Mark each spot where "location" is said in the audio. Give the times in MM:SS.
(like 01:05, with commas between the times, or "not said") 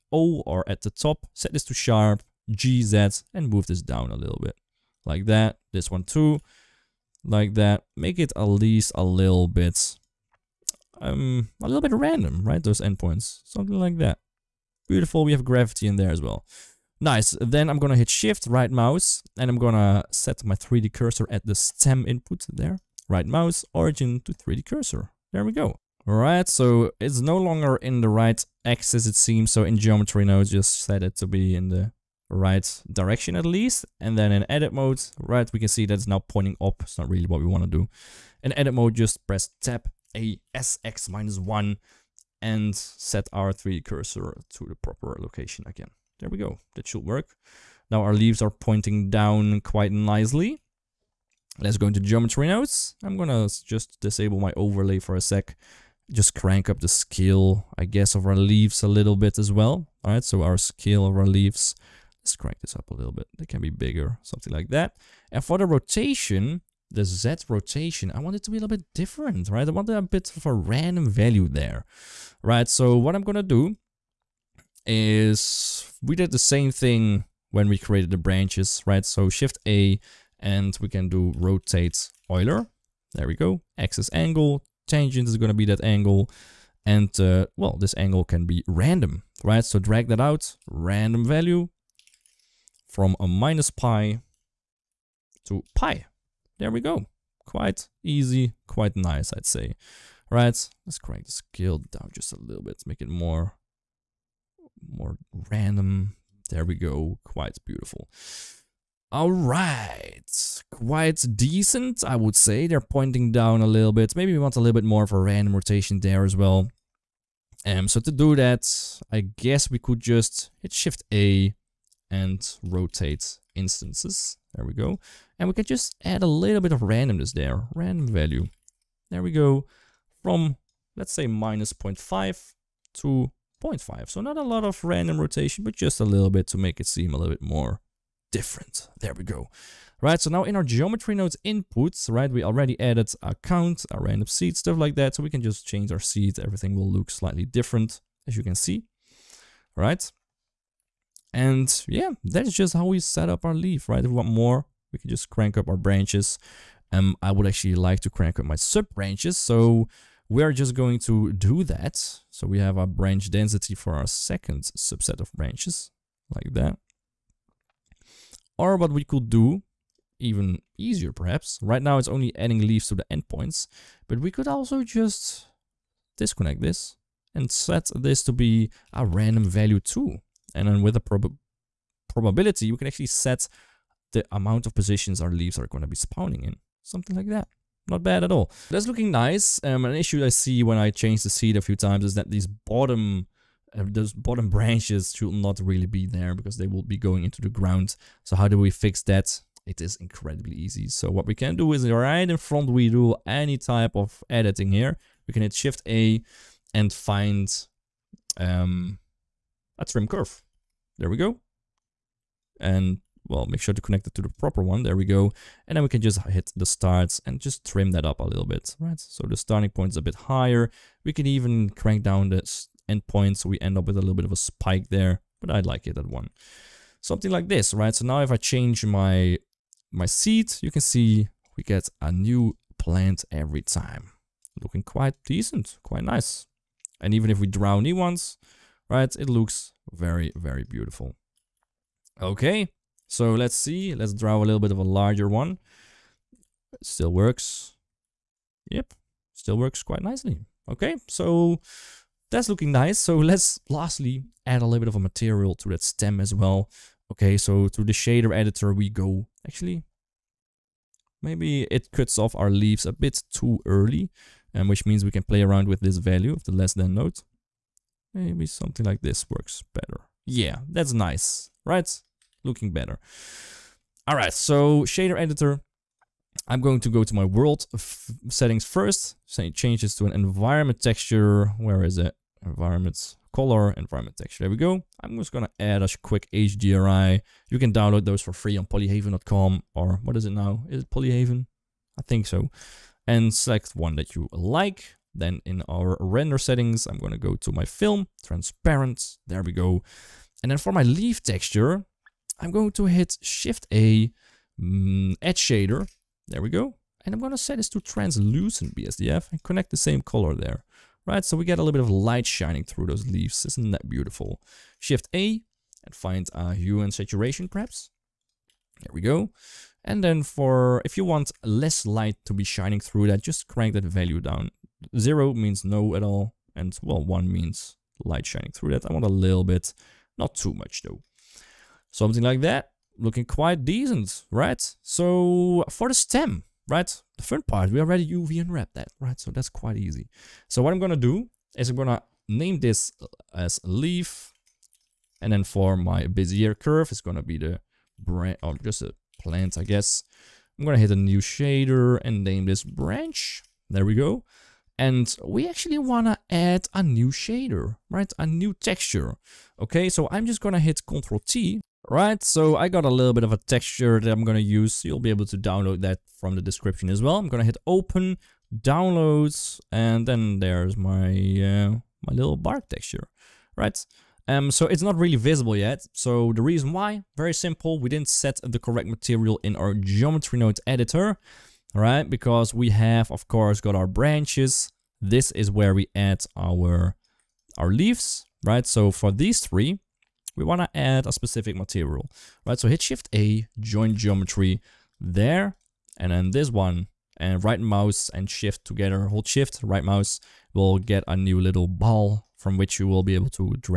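00:45.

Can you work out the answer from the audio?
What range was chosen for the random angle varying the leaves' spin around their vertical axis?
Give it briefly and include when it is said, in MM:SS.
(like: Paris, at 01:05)
-pi to pi, at 01:33.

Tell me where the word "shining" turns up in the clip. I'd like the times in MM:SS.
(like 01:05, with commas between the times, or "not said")
05:12, 05:22, 05:28.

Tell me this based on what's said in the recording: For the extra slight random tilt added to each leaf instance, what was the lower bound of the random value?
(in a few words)
-0.5.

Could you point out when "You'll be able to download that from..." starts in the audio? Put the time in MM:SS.
06:04.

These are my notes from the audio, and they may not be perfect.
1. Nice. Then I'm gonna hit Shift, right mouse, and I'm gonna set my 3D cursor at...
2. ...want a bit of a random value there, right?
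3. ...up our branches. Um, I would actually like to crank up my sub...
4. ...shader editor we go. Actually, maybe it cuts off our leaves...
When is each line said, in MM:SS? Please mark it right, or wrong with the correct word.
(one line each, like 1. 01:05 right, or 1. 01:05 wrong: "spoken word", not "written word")
1. 00:17 right
2. 01:09 right
3. 02:35 right
4. 04:17 right.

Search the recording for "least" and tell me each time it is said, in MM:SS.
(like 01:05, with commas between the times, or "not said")
00:08, 00:33.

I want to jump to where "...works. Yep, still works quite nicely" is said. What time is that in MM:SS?
04:07.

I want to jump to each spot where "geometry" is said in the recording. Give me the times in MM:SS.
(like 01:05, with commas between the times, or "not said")
00:29, 00:52, 02:20, 06:19, 06:33.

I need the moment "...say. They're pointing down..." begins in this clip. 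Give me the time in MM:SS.
01:52.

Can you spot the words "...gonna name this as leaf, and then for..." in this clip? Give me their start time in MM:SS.
05:41.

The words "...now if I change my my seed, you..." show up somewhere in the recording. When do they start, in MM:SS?
03:48.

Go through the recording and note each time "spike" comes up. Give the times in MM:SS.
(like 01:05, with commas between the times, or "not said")
03:44.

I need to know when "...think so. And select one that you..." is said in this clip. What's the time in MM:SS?
04:52.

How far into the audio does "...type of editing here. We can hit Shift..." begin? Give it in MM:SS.
03:23.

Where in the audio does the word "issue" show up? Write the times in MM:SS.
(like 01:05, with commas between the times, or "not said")
03:09.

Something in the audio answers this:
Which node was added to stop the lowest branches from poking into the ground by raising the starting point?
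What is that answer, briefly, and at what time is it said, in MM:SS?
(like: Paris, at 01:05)
trim curve, at 03:29.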